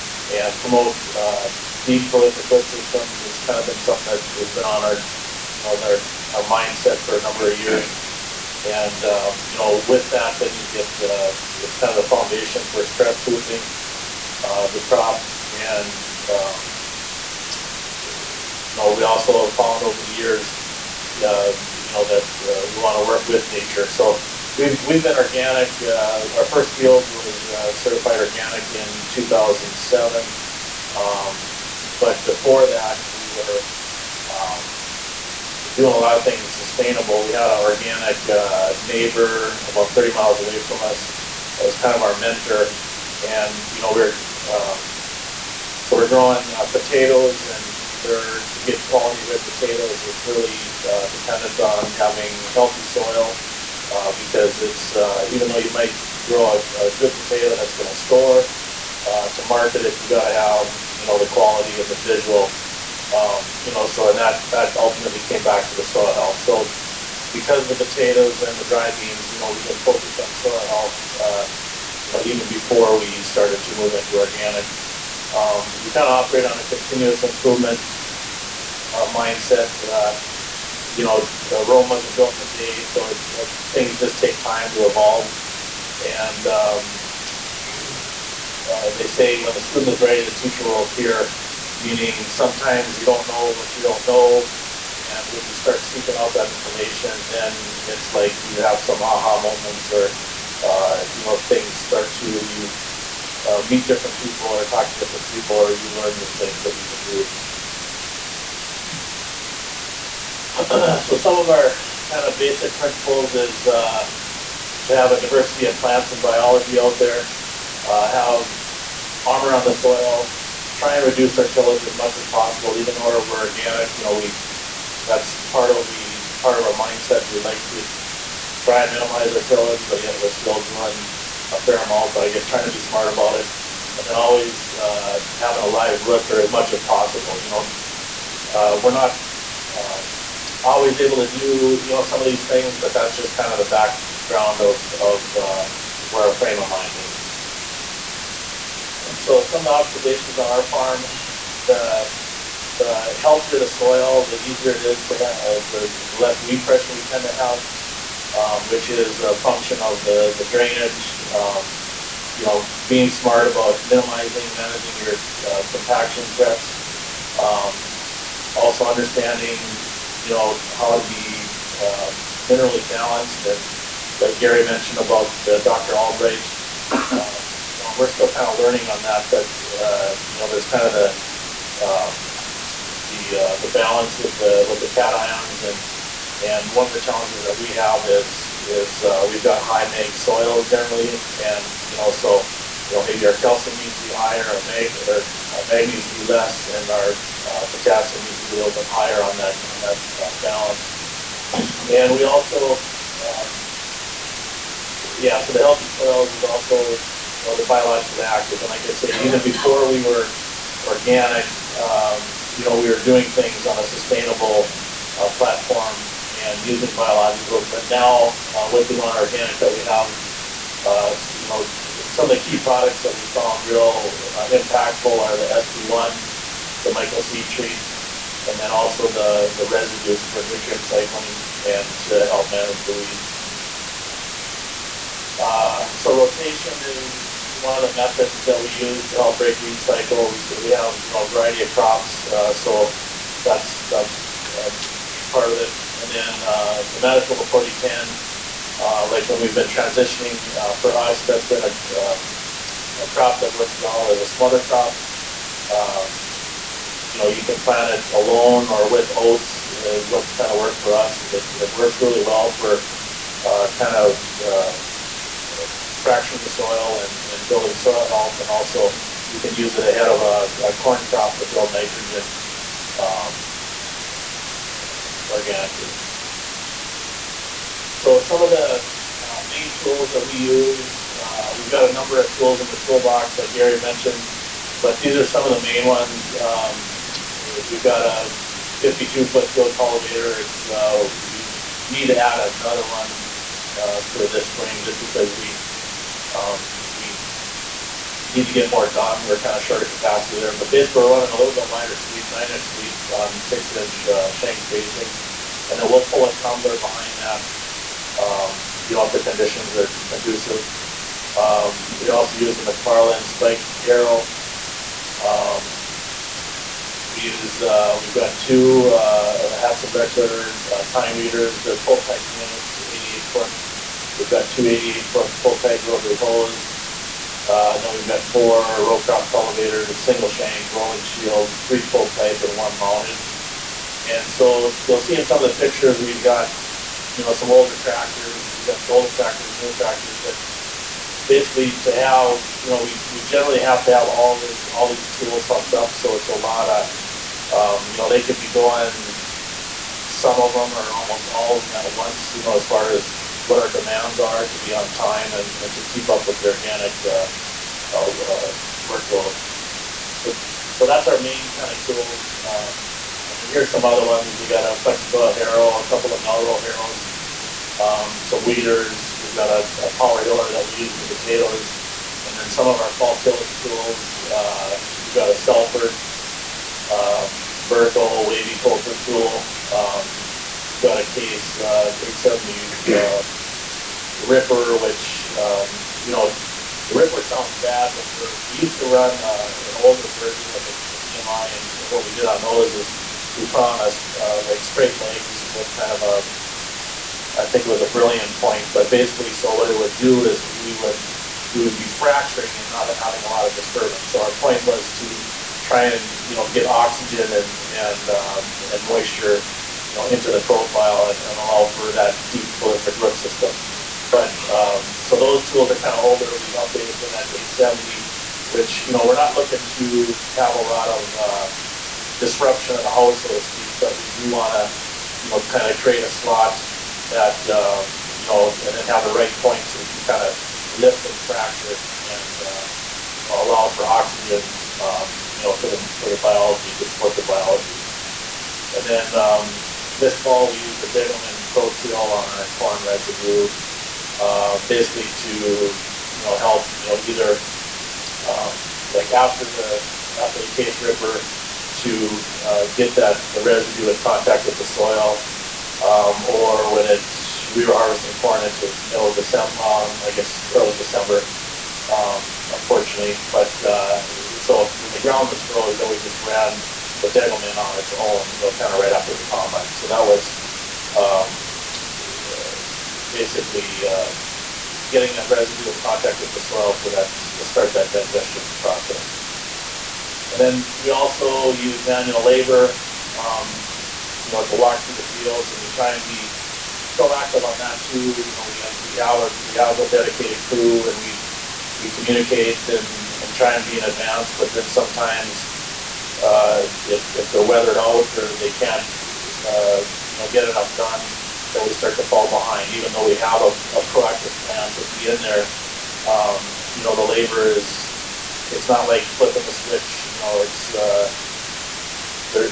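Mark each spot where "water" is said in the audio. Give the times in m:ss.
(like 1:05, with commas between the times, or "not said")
not said.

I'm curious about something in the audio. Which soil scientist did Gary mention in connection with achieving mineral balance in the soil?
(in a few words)
Dr. Albrecht.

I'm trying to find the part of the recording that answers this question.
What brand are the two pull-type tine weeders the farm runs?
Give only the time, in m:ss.
5:19.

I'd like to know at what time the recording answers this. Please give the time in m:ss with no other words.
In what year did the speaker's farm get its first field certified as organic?
0:29.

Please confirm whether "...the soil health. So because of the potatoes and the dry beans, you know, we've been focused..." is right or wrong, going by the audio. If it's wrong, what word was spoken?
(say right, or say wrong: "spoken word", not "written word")
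right.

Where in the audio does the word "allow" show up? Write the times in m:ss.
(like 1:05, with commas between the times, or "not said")
6:51, 7:13.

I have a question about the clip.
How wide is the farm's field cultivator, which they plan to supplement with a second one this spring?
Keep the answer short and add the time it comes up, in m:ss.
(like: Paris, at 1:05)
52 feet, at 4:48.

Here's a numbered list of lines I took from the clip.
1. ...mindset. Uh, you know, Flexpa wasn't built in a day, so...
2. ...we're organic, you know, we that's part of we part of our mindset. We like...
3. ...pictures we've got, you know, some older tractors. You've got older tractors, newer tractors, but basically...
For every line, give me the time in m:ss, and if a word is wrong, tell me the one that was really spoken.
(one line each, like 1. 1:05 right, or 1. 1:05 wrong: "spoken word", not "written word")
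1. 1:19 wrong: "Rome", not "Flexpa"
2. 2:03 right
3. 5:35 right.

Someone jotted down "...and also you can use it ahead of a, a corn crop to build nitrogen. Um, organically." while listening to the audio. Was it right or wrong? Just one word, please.
right.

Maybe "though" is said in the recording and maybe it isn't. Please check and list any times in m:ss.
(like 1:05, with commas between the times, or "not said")
0:55, 2:02, 8:22.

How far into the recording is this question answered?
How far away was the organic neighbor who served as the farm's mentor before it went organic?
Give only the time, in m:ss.
0:39.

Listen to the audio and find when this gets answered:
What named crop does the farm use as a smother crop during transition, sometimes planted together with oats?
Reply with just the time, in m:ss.
4:06.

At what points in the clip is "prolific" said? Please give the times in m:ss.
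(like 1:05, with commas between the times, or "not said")
0:02, 6:52.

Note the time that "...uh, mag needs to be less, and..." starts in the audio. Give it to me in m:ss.
3:15.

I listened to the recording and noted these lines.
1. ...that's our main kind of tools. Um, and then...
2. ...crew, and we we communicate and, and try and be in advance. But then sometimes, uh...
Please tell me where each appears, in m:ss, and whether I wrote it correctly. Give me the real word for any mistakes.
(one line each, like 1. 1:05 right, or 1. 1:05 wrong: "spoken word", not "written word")
1. 6:00 right
2. 8:10 right.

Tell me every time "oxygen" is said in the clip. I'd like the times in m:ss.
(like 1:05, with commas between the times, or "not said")
6:46, 7:13.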